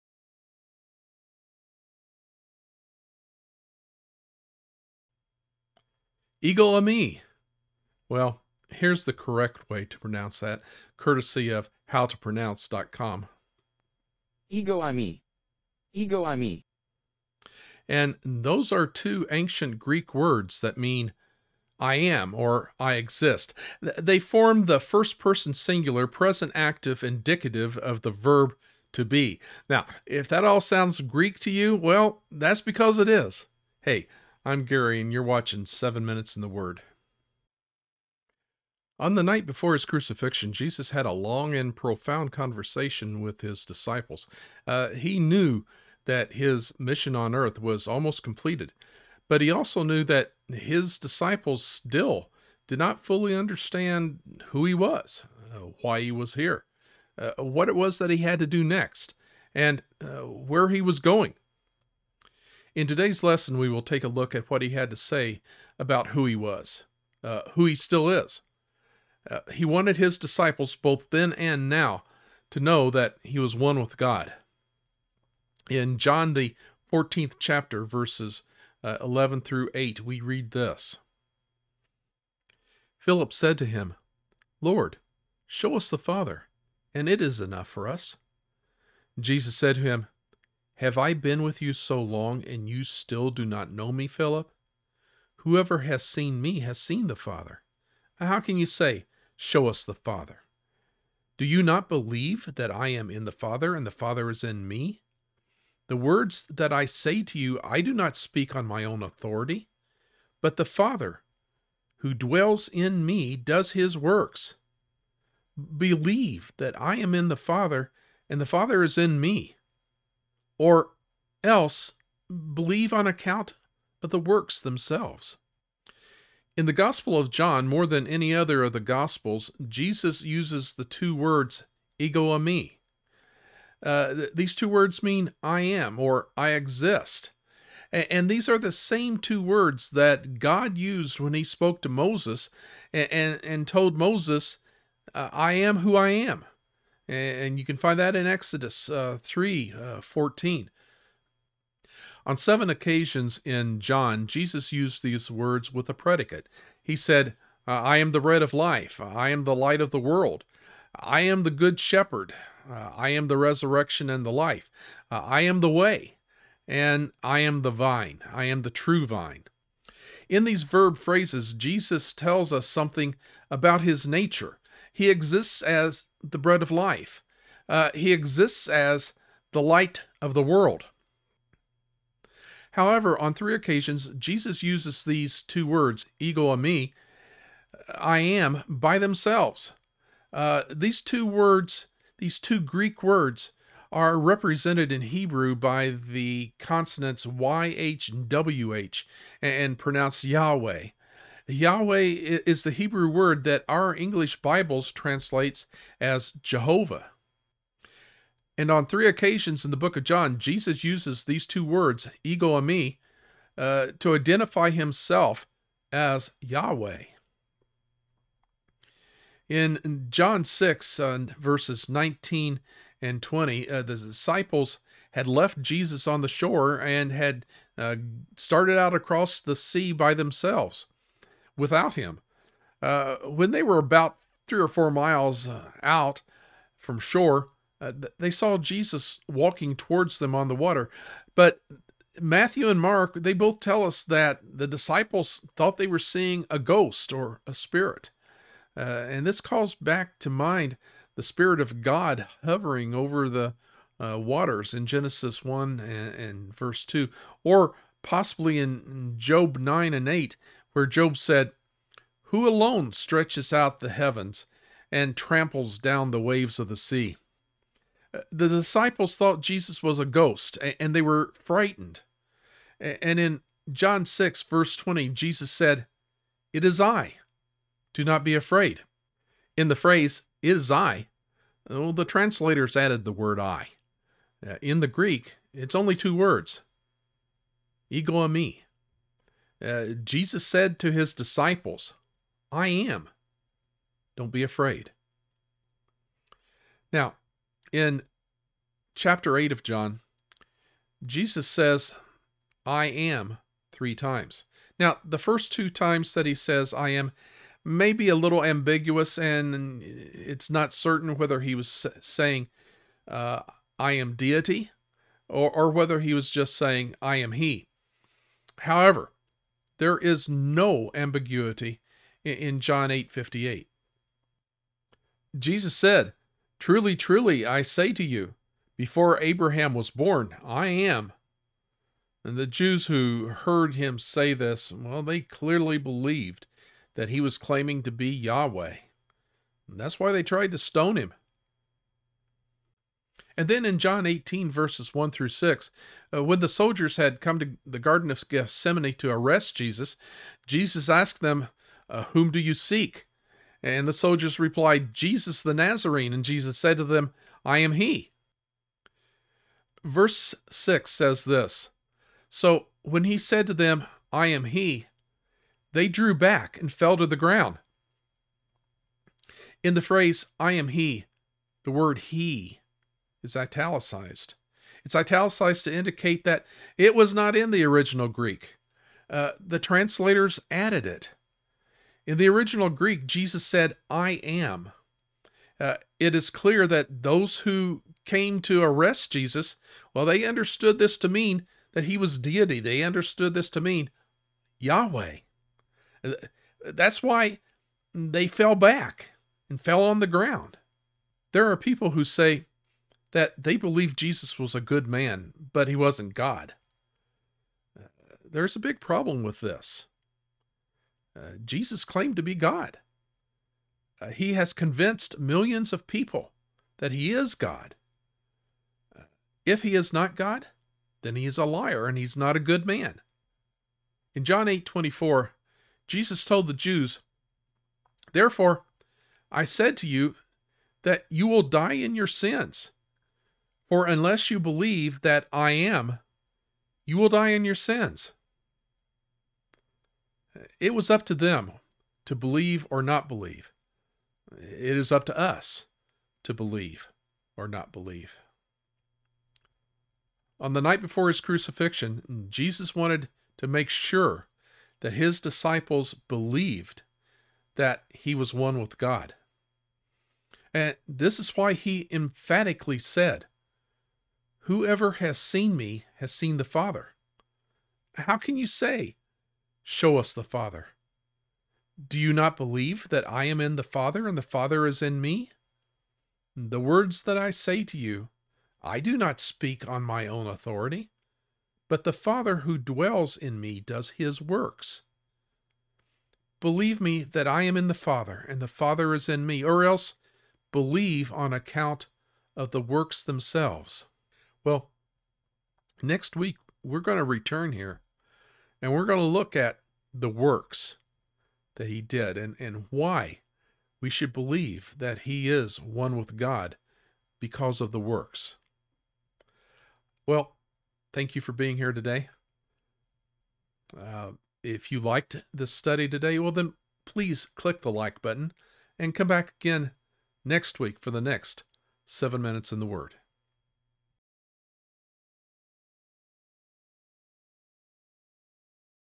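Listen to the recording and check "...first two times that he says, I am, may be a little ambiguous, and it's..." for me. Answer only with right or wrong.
right.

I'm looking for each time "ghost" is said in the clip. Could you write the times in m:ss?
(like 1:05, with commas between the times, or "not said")
4:06, 4:30.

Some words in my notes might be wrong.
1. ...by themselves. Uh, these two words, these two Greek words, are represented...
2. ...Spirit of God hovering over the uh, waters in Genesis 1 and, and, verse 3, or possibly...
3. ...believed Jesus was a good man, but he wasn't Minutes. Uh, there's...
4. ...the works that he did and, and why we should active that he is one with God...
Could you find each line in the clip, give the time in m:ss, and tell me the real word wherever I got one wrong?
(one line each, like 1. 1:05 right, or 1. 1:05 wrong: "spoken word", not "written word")
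1. 3:08 right
2. 4:11 wrong: "2", not "3"
3. 6:43 wrong: "God", not "Minutes"
4. 8:19 wrong: "believe", not "active".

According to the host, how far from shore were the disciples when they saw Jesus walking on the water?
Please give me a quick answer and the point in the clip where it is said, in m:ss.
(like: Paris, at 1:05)
3 or 4 miles, at 3:54.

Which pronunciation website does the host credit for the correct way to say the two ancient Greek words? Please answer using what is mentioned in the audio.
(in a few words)
howtopronounce.com.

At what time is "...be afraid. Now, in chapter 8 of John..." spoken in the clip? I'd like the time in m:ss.
4:54.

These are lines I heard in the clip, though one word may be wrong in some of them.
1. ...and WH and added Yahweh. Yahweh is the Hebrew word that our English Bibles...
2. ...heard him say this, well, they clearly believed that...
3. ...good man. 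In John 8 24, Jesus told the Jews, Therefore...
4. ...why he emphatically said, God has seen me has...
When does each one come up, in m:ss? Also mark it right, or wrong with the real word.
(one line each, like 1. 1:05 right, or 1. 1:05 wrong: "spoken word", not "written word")
1. 3:18 wrong: "pronounced", not "added"
2. 5:33 right
3. 7:02 right
4. 7:41 wrong: "Whoever", not "God".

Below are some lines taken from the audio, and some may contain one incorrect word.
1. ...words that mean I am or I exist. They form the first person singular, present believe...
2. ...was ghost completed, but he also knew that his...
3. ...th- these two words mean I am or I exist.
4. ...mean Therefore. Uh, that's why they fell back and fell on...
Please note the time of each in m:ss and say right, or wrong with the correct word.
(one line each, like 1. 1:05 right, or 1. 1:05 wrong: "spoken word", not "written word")
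1. 0:20 wrong: "active", not "believe"
2. 0:47 wrong: "almost", not "ghost"
3. 2:14 right
4. 6:33 wrong: "Yahweh", not "Therefore".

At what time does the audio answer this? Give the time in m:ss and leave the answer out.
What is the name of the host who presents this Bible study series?
0:34.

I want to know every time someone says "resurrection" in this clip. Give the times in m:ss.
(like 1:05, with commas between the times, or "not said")
2:43.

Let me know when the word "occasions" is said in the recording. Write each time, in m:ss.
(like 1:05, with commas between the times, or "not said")
2:32, 3:03, 3:29.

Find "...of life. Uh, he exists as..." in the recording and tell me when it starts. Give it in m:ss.
2:56.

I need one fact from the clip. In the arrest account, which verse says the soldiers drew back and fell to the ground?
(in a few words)
Verse 6.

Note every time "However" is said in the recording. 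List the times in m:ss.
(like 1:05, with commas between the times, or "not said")
3:02, 5:18.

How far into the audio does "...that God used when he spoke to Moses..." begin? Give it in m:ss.
2:19.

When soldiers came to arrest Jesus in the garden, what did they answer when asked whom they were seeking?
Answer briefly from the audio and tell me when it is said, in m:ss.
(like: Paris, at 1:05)
Jesus the Nazarene, at 5:54.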